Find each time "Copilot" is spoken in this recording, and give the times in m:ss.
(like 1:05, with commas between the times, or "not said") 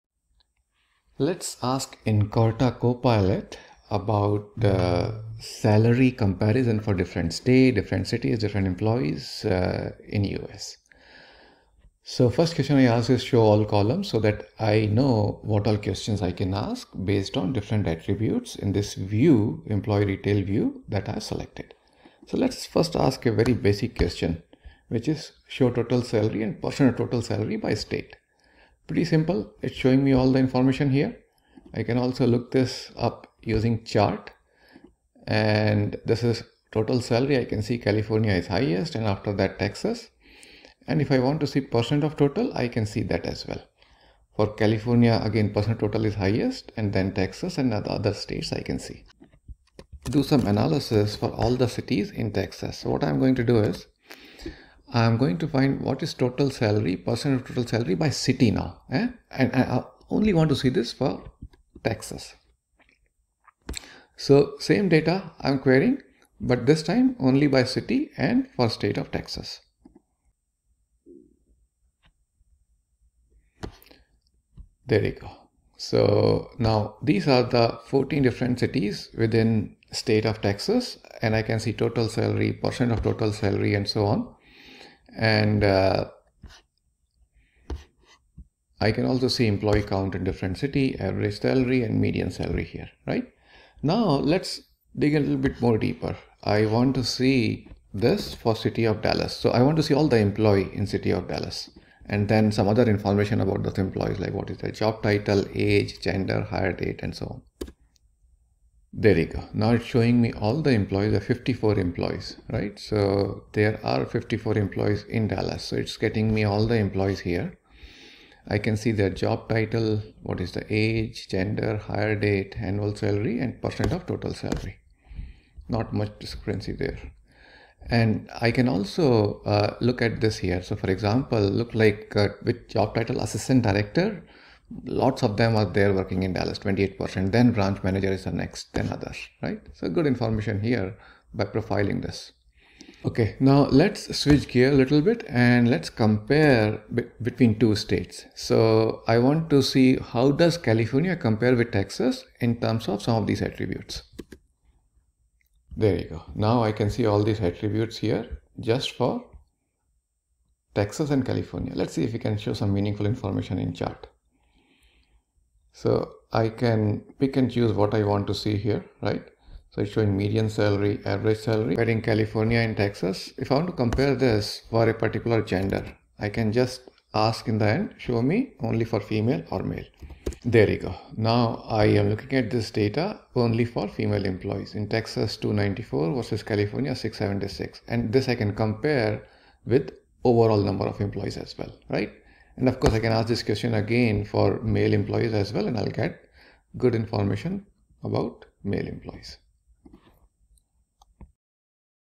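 0:02.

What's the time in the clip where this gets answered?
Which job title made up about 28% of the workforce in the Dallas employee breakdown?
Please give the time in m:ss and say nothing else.
2:13.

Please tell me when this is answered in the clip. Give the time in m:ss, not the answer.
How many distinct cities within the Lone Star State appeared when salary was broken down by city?
1:17.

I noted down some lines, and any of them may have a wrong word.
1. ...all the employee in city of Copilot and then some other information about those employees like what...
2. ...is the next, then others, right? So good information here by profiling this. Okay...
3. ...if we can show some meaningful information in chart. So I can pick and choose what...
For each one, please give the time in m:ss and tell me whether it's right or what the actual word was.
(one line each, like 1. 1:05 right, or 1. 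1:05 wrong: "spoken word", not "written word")
1. 1:39 wrong: "Dallas", not "Copilot"
2. 2:18 right
3. 2:42 right.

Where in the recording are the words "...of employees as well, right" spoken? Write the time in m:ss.
3:10.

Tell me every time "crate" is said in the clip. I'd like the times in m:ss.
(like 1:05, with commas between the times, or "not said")
not said.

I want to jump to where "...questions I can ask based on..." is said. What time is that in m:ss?
0:15.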